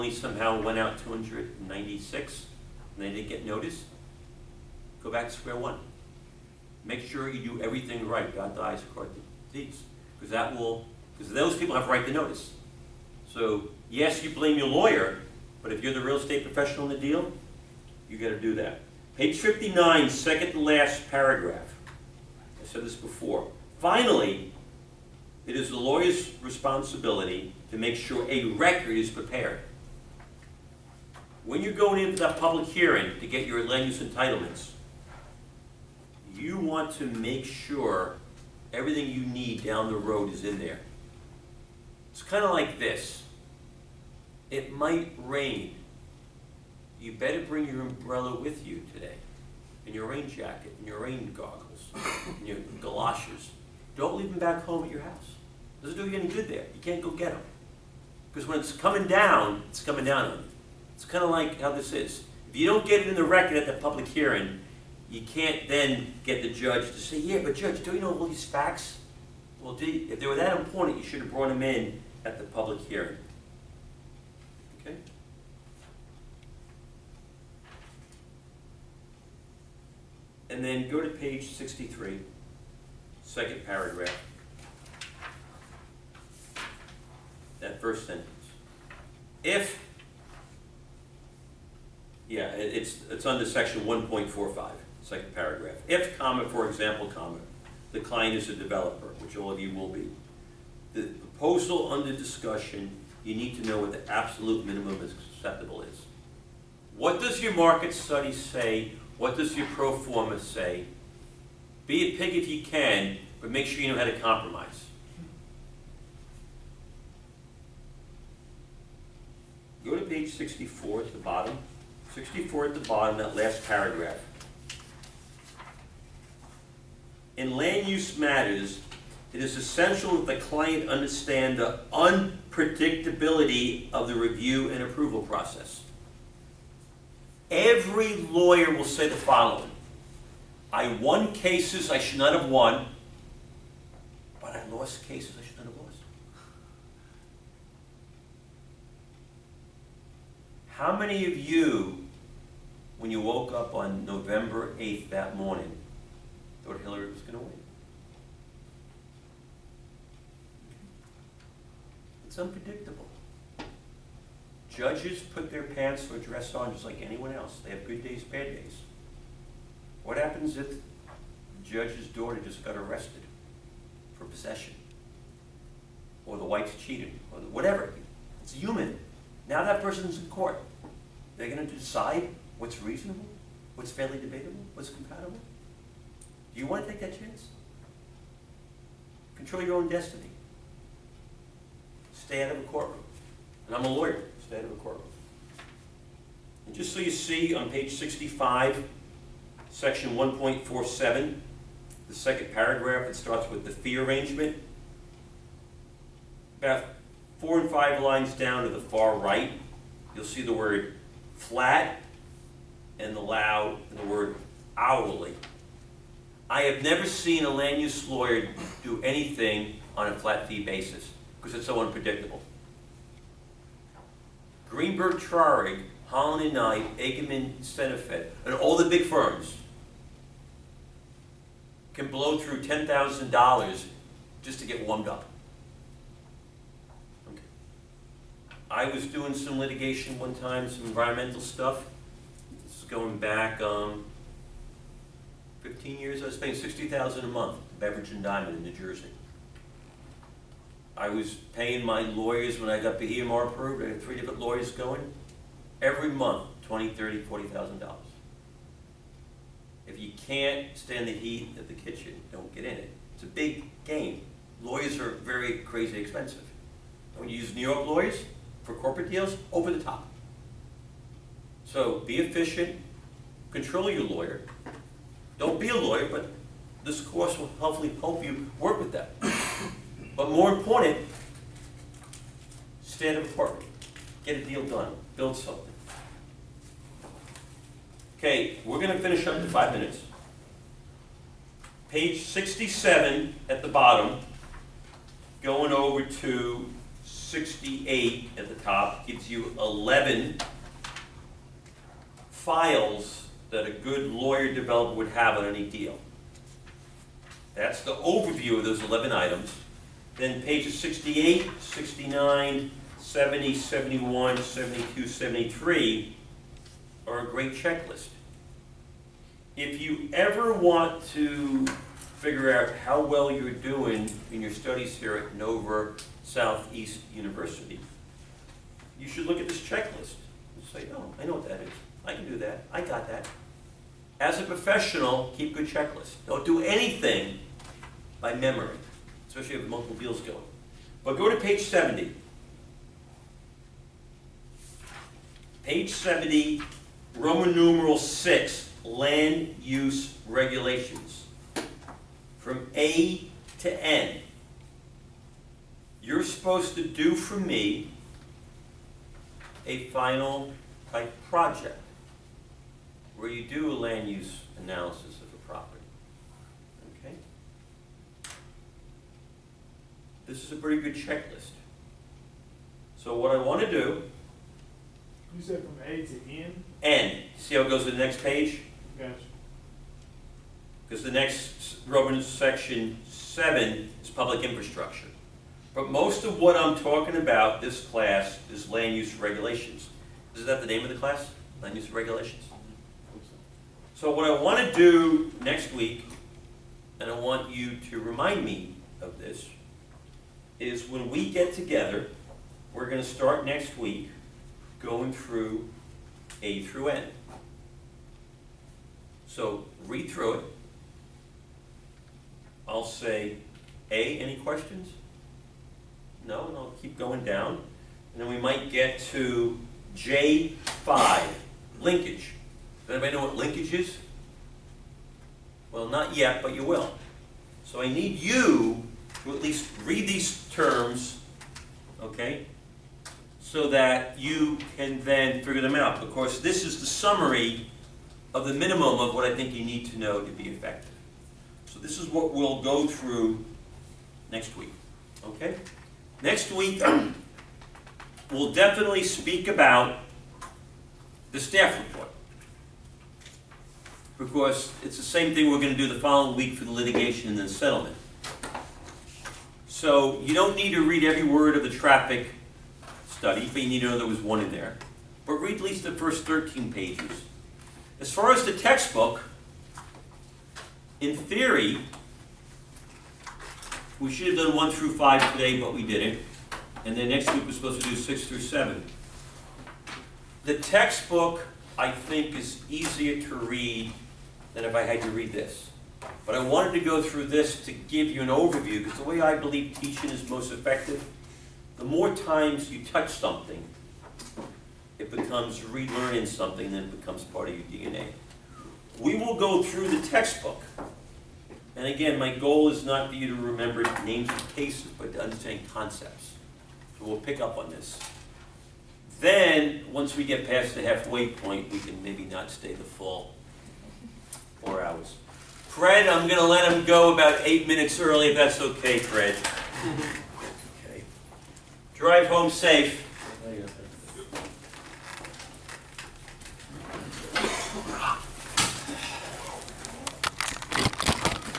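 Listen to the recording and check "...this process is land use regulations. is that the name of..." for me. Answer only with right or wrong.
wrong.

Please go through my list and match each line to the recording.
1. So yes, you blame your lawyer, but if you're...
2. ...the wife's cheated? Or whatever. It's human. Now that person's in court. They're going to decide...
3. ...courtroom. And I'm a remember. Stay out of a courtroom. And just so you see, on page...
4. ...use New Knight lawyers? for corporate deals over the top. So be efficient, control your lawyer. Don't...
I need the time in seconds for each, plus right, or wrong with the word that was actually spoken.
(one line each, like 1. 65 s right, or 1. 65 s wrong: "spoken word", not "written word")
1. 13 s right
2. 176 s right
3. 192 s wrong: "lawyer", not "remember"
4. 267 s wrong: "York", not "Knight".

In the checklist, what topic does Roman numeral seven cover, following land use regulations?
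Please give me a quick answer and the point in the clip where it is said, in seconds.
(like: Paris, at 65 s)
public infrastructure, at 384 s.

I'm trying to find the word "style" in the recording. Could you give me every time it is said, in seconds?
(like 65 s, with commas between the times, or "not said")
not said.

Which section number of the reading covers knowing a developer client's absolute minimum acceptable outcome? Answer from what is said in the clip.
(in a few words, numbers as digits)
1.45.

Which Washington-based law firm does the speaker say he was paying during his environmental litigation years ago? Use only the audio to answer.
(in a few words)
Beveridge and Diamond.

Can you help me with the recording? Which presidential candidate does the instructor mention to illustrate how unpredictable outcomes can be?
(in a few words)
Hillary.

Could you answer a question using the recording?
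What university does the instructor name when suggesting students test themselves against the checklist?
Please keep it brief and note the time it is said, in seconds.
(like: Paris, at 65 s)
Nova Southeast University, at 325 s.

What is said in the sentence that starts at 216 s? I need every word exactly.
I have never seen a land use lawyer do anything on a flat fee basis because it's so unpredictable.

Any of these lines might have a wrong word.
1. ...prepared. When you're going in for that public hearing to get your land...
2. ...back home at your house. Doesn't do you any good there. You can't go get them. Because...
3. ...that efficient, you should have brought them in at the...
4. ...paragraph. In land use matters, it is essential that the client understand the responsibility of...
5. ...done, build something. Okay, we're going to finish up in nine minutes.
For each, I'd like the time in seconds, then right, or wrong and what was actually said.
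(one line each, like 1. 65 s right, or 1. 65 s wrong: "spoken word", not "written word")
1. 29 s right
2. 54 s right
3. 70 s wrong: "important", not "efficient"
4. 123 s wrong: "unpredictability", not "responsibility"
5. 284 s wrong: "five", not "nine".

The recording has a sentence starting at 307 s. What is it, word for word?
That's the overview of those 11 items.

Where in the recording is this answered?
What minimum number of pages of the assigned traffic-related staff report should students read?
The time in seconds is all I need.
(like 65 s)
466 s.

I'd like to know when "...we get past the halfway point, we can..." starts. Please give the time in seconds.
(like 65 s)
510 s.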